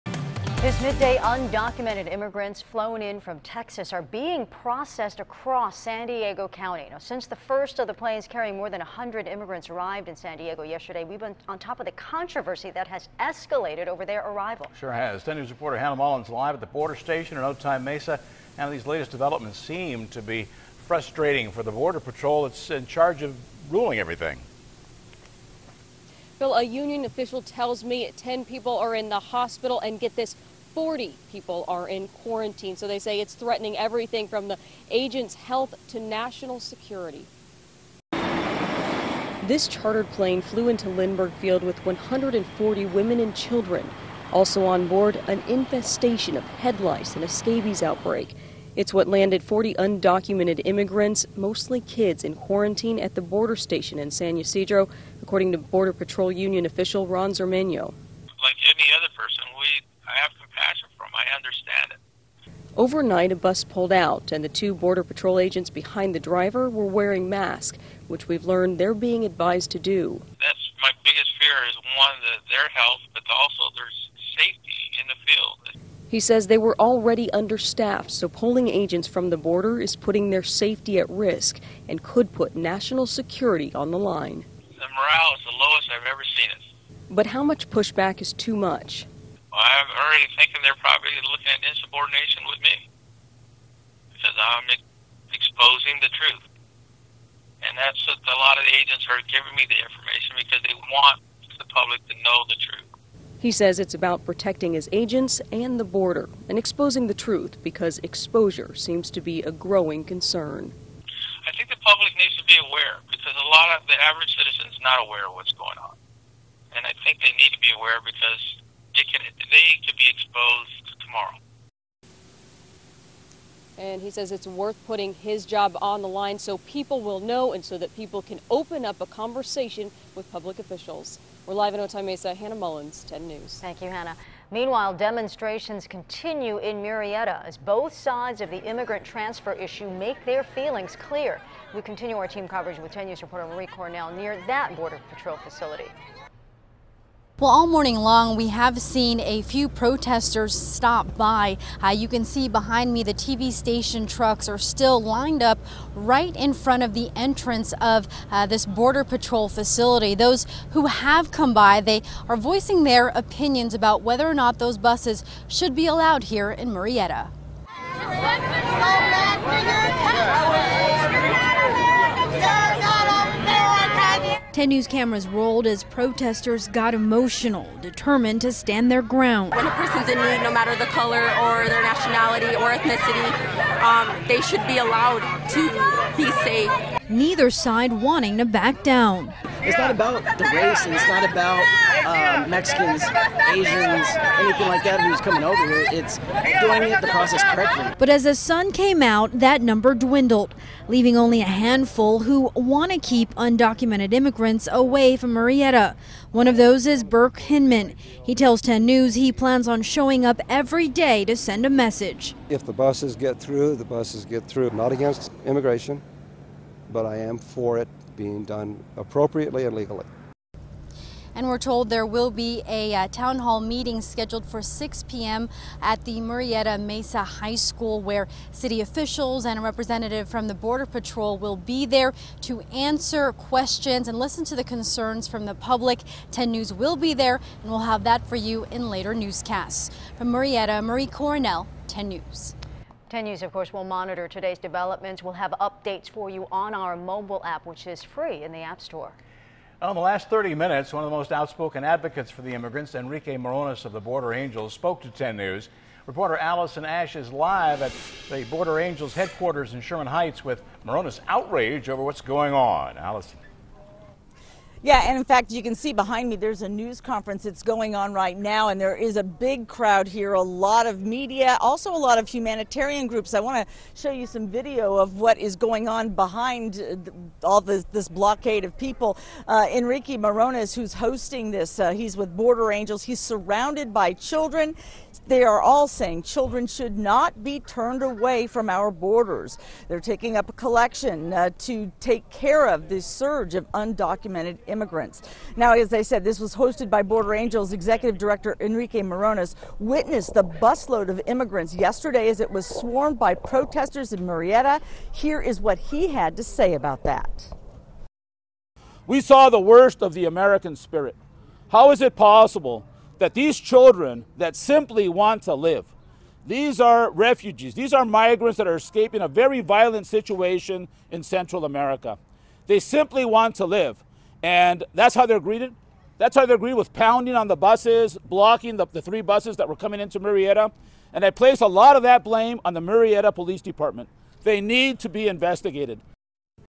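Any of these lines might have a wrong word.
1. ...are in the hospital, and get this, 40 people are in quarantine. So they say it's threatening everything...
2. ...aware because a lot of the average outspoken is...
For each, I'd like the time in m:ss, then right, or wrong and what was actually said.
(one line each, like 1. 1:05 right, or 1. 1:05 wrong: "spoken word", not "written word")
1. 0:28 right
2. 1:52 wrong: "citizen", not "outspoken".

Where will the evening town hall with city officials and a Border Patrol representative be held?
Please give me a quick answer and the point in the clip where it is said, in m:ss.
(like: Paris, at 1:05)
Murrieta Mesa High School, at 3:46.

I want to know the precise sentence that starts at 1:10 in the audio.
That's my biggest fear is one, that their health, but also their safety in the field.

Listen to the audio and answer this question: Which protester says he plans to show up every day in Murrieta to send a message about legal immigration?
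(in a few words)
Burke Hinman.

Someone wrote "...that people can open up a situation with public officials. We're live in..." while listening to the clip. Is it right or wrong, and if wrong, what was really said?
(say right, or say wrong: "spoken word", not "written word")
wrong: "conversation", not "situation".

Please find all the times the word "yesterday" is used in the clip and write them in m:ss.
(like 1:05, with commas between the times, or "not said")
0:10, 5:01.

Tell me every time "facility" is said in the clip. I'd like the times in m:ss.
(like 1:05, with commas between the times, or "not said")
2:25, 2:39.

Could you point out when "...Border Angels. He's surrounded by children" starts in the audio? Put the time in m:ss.
4:42.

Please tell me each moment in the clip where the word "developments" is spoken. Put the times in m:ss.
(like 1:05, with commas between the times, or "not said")
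0:19, 4:04.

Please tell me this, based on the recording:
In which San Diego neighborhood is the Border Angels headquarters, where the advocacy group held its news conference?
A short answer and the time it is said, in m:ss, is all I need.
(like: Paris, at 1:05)
Sherman Heights, at 4:19.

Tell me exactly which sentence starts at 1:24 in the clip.
The morale is the lowest I've ever seen it.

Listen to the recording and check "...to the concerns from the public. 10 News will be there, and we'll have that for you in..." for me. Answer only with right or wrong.
right.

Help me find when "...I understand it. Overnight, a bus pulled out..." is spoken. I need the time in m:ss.
1:01.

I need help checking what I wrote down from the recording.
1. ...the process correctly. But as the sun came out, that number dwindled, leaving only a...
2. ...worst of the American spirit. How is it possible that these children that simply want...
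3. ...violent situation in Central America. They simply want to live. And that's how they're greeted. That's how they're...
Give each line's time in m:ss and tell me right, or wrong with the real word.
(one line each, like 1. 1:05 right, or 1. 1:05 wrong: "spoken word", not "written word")
1. 3:17 right
2. 5:09 right
3. 5:19 right.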